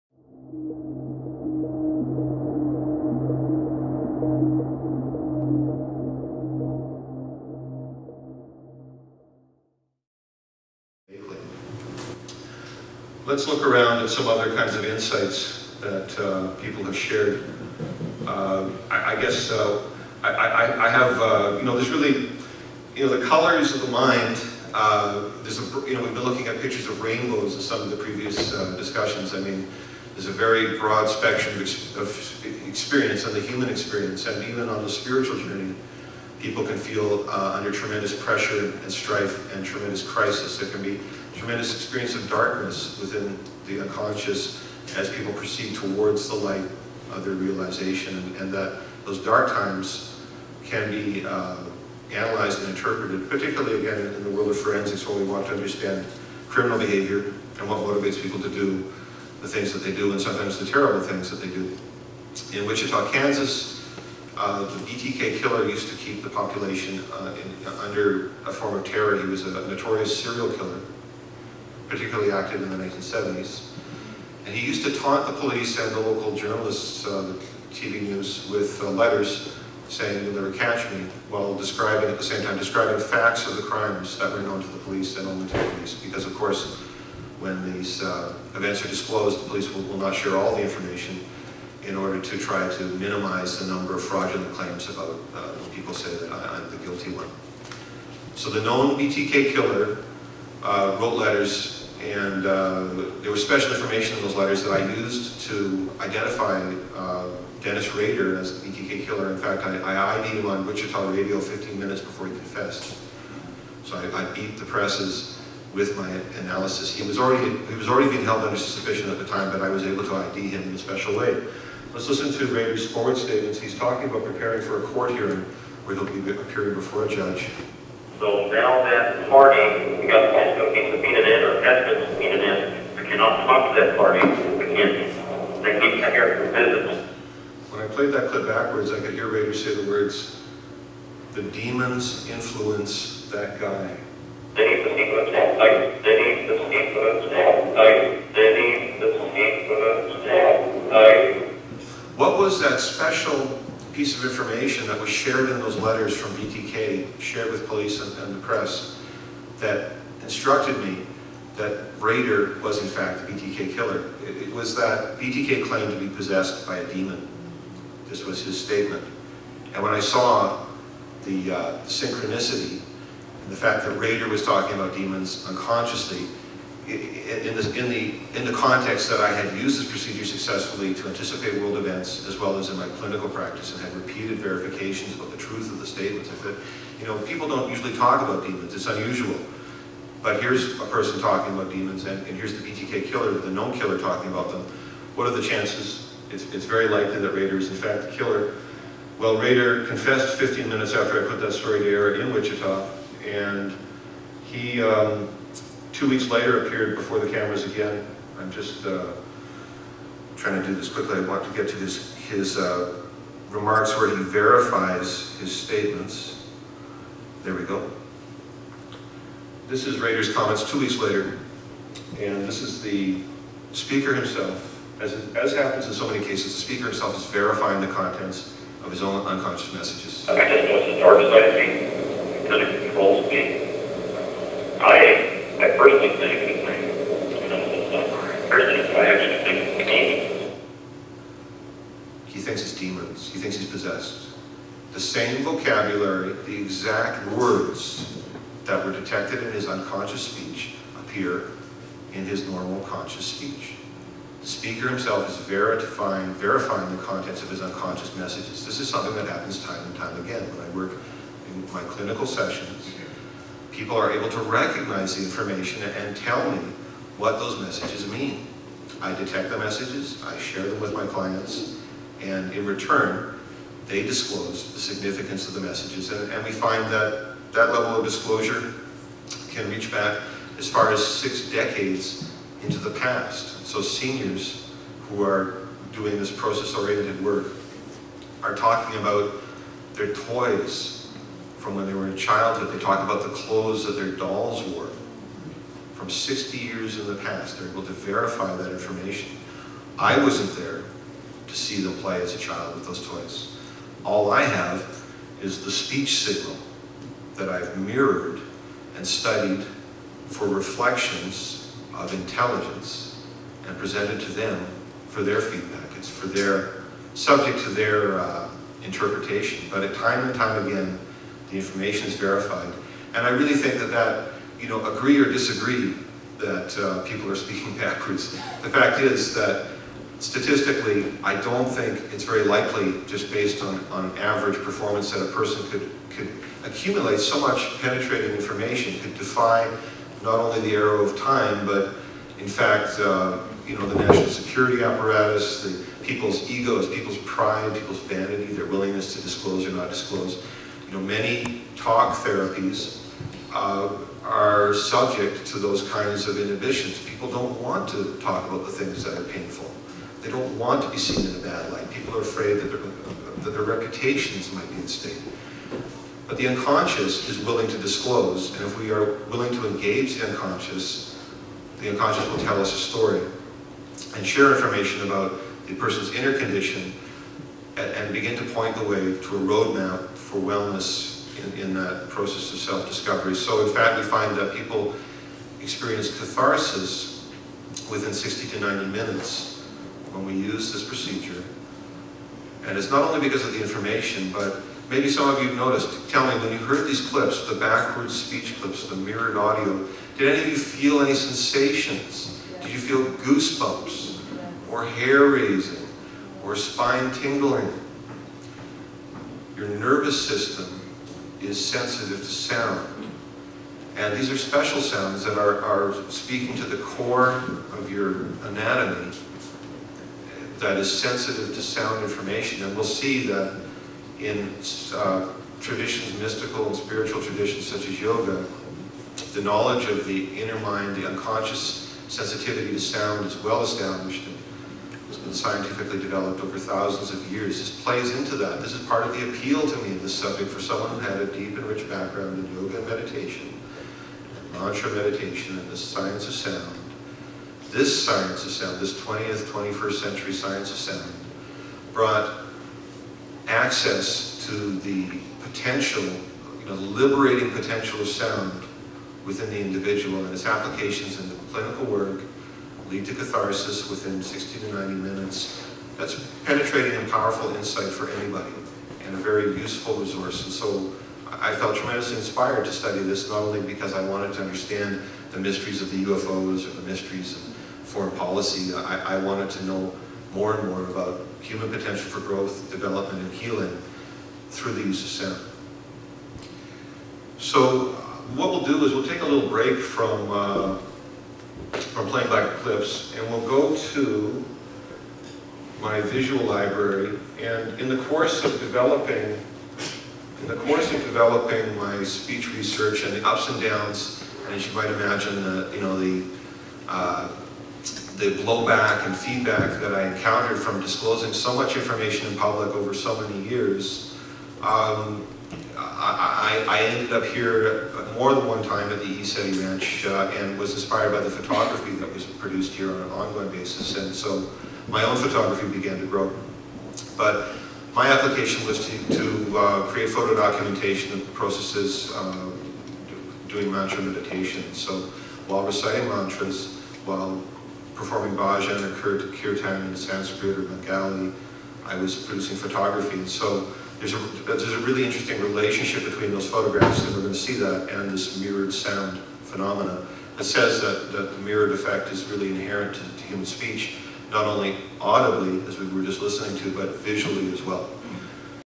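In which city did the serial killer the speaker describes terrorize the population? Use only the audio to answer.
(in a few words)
Wichita, Kansas.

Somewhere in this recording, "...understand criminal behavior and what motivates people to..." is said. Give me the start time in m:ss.
0:55.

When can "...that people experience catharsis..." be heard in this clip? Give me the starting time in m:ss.
6:24.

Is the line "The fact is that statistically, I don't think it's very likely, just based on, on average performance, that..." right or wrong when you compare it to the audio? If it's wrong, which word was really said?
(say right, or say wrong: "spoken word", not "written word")
right.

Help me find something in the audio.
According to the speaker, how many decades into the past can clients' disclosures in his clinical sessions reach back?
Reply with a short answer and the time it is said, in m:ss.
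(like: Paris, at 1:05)
6 decades, at 4:41.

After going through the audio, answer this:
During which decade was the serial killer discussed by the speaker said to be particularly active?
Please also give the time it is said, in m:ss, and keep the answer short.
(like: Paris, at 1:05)
1970s, at 1:12.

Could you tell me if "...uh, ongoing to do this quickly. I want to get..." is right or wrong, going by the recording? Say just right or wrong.
wrong.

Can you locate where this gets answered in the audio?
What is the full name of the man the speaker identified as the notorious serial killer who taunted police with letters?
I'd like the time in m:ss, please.
1:47.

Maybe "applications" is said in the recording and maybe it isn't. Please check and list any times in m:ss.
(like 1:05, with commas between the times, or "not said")
7:40, 8:48.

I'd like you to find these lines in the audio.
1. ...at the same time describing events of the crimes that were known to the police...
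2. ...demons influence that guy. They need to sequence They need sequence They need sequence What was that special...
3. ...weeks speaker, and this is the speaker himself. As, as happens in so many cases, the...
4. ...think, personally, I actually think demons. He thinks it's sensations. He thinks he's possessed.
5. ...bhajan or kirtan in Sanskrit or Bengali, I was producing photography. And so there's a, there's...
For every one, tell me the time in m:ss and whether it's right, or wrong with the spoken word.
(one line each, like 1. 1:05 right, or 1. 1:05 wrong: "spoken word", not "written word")
1. 1:22 wrong: "facts", not "events"
2. 2:21 right
3. 3:40 wrong: "later", not "speaker"
4. 3:56 wrong: "demons", not "sensations"
5. 8:58 right.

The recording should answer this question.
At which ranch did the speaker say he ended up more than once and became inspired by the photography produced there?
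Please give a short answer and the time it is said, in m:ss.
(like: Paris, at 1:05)
ECETI Ranch, at 8:39.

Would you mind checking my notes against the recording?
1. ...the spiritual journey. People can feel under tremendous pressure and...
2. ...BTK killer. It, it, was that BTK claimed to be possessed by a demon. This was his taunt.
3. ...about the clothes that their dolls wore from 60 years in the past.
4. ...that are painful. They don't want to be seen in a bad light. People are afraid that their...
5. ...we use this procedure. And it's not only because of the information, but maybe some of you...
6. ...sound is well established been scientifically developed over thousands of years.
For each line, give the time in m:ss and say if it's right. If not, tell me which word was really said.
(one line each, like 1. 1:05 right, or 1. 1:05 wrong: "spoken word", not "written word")
1. 0:34 right
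2. 2:43 wrong: "statement", not "taunt"
3. 4:53 right
4. 5:59 right
5. 6:30 right
6. 7:12 right.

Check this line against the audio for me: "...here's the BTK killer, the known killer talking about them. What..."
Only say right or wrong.
right.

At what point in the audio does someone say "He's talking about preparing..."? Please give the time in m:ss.
2:03.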